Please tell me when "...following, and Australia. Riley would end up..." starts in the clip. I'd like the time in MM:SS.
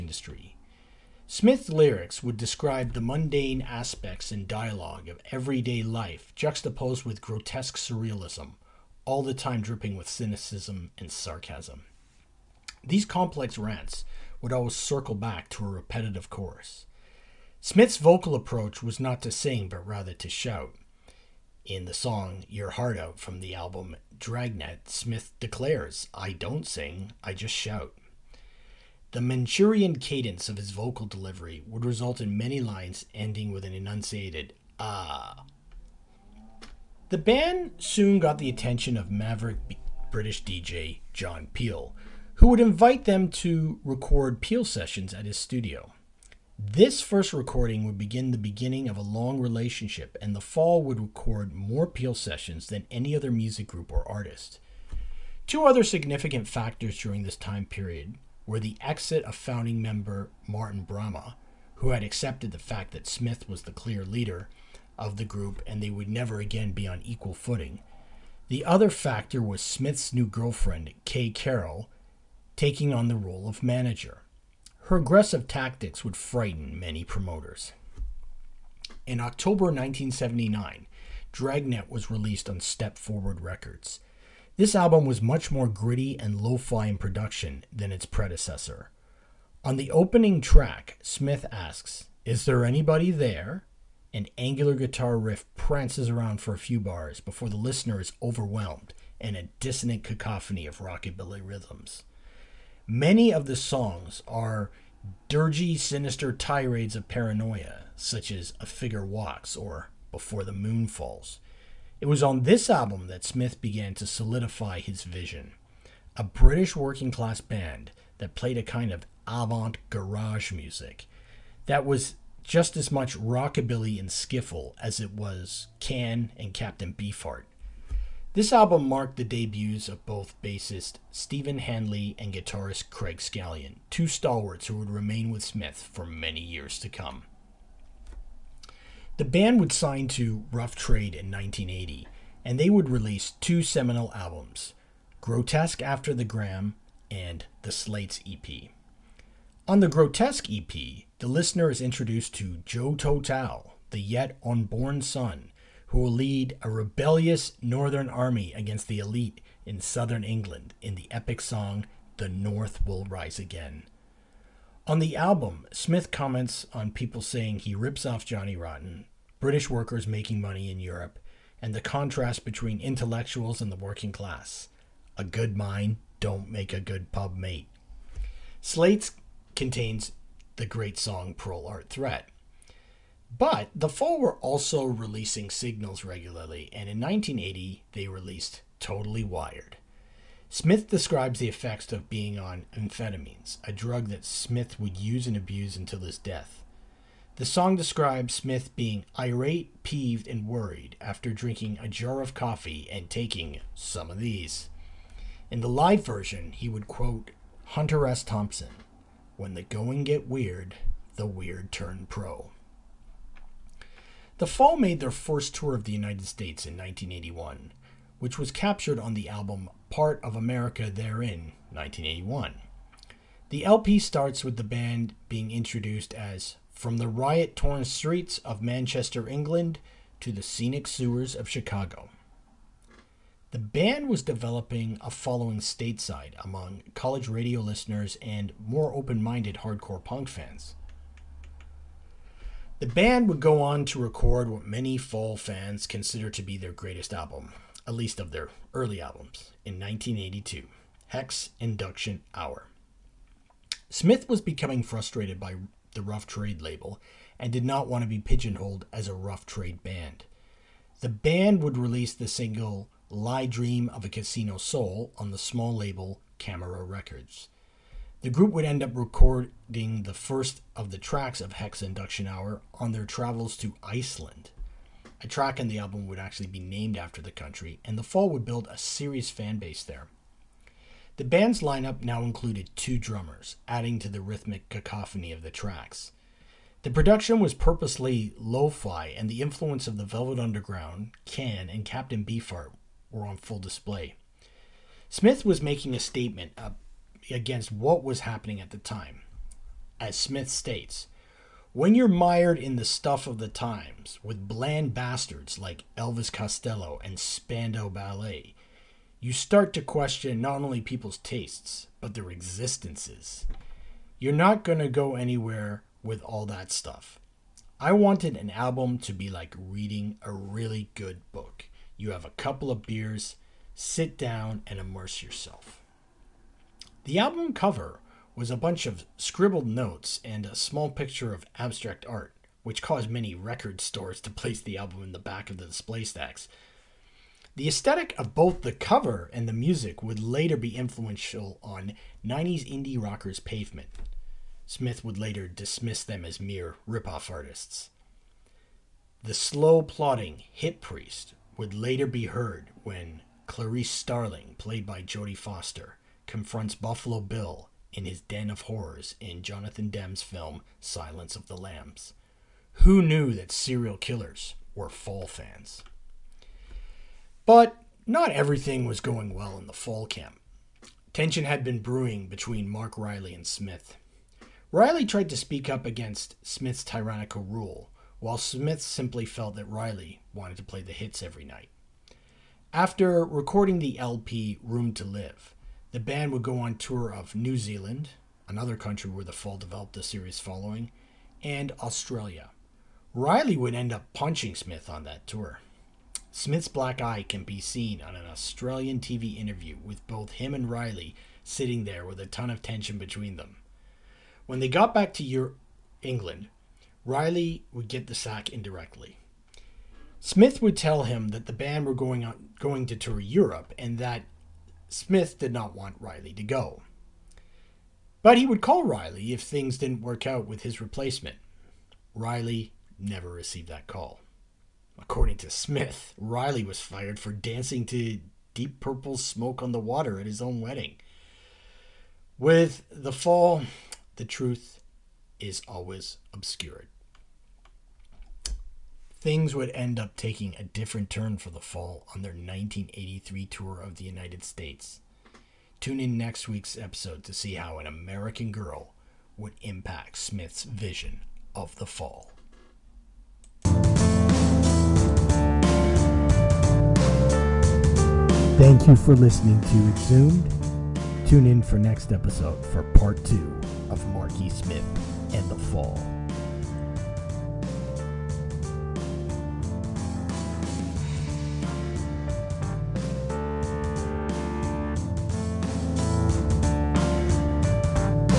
06:30.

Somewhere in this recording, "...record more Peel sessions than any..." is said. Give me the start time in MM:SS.
00:50.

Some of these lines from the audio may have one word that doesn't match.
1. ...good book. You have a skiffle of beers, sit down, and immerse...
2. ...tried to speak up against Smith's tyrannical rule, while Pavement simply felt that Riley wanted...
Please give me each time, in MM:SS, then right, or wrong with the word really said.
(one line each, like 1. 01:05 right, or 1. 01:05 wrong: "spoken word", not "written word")
1. 05:20 wrong: "couple", not "skiffle"
2. 06:15 wrong: "Smith", not "Pavement".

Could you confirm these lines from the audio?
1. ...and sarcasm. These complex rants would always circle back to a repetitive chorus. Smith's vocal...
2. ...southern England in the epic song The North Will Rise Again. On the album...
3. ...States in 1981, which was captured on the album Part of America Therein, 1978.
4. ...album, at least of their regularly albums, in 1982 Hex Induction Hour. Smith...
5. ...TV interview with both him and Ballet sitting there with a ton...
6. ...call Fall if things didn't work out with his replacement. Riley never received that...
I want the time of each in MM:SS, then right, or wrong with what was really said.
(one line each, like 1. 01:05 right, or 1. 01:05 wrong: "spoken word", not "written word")
1. 00:10 right
2. 02:39 right
3. 03:36 wrong: "1981", not "1978"
4. 04:07 wrong: "early", not "regularly"
5. 06:39 wrong: "Riley", not "Ballet"
6. 06:58 wrong: "Riley", not "Fall".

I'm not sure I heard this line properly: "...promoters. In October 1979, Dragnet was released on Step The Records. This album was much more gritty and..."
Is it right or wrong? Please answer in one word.
wrong.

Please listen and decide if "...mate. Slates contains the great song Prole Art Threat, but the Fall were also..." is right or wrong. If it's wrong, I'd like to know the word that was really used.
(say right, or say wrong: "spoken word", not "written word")
right.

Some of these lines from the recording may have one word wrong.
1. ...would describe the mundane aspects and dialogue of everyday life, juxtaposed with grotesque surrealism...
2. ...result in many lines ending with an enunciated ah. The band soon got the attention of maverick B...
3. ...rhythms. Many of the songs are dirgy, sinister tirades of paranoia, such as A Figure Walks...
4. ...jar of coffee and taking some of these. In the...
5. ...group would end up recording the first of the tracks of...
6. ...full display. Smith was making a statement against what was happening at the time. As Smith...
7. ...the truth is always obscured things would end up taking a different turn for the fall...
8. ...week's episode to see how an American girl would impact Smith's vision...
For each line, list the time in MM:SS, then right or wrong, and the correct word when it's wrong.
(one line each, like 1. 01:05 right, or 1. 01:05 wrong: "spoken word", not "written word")
1. 00:02 right
2. 00:31 right
3. 01:41 right
4. 03:21 right
5. 04:28 right
6. 04:53 right
7. 07:14 right
8. 07:26 right.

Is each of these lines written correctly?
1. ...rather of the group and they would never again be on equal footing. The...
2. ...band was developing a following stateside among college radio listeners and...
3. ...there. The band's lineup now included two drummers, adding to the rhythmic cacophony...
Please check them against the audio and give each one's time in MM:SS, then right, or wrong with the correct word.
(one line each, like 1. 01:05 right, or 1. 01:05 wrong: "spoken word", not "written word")
1. 01:04 wrong: "leader", not "rather"
2. 03:53 right
3. 04:39 right.